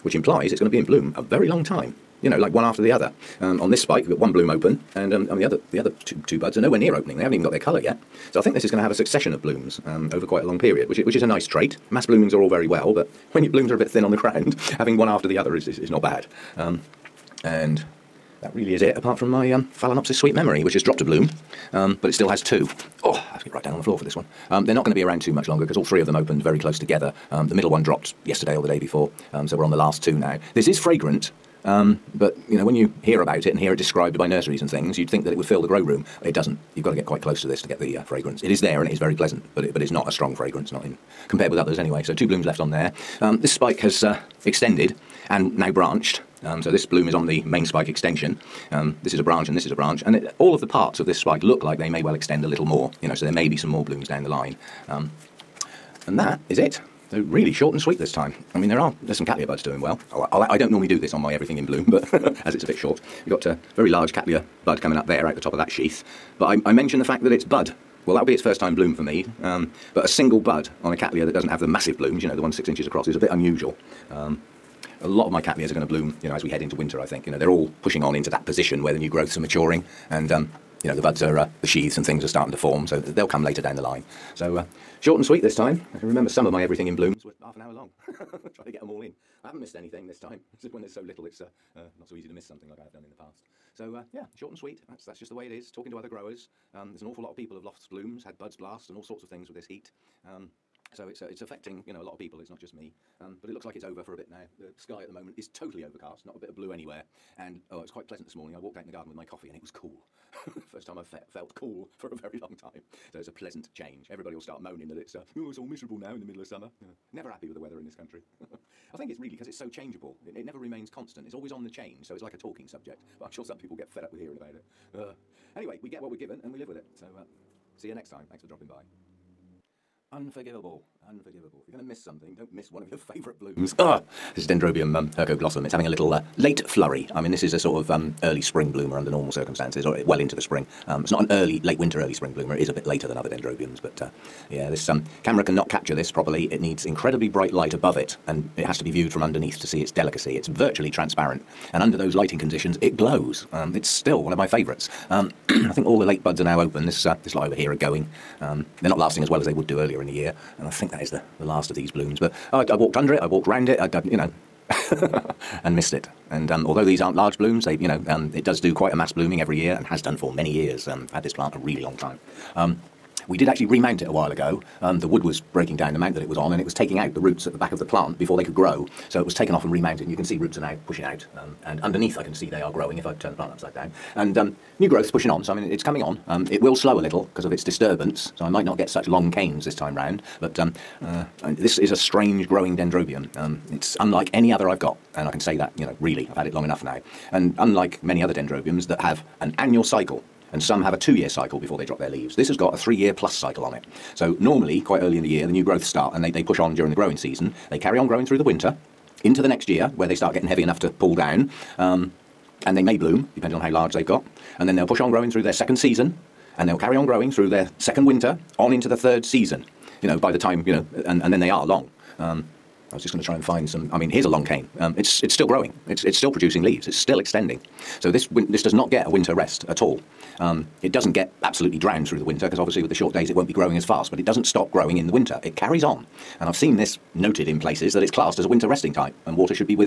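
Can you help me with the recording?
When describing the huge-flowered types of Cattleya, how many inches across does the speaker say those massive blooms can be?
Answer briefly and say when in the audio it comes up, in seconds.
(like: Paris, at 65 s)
6, at 72 s.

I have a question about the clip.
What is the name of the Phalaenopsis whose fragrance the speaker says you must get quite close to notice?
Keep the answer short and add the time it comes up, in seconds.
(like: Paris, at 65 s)
Sweet Memory, at 20 s.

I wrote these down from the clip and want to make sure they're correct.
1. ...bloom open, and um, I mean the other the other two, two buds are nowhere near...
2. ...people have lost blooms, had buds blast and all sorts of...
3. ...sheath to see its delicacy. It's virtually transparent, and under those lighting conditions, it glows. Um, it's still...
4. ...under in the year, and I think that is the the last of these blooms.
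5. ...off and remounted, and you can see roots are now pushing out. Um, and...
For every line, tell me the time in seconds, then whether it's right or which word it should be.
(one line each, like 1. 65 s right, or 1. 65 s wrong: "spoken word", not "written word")
1. 4 s right
2. 97 s right
3. 149 s wrong: "underneath", not "sheath"
4. 159 s wrong: "earlier", not "under"
5. 179 s right.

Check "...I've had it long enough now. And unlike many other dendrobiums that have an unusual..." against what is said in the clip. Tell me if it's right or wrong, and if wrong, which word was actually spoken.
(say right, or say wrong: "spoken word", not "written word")
wrong: "annual", not "unusual".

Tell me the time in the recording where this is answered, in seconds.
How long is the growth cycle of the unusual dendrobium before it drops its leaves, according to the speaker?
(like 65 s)
202 s.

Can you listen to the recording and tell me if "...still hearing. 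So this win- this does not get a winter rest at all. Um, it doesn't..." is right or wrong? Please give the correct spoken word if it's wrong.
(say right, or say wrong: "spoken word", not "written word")
wrong: "extending", not "hearing".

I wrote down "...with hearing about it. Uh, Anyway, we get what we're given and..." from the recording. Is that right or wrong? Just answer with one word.
right.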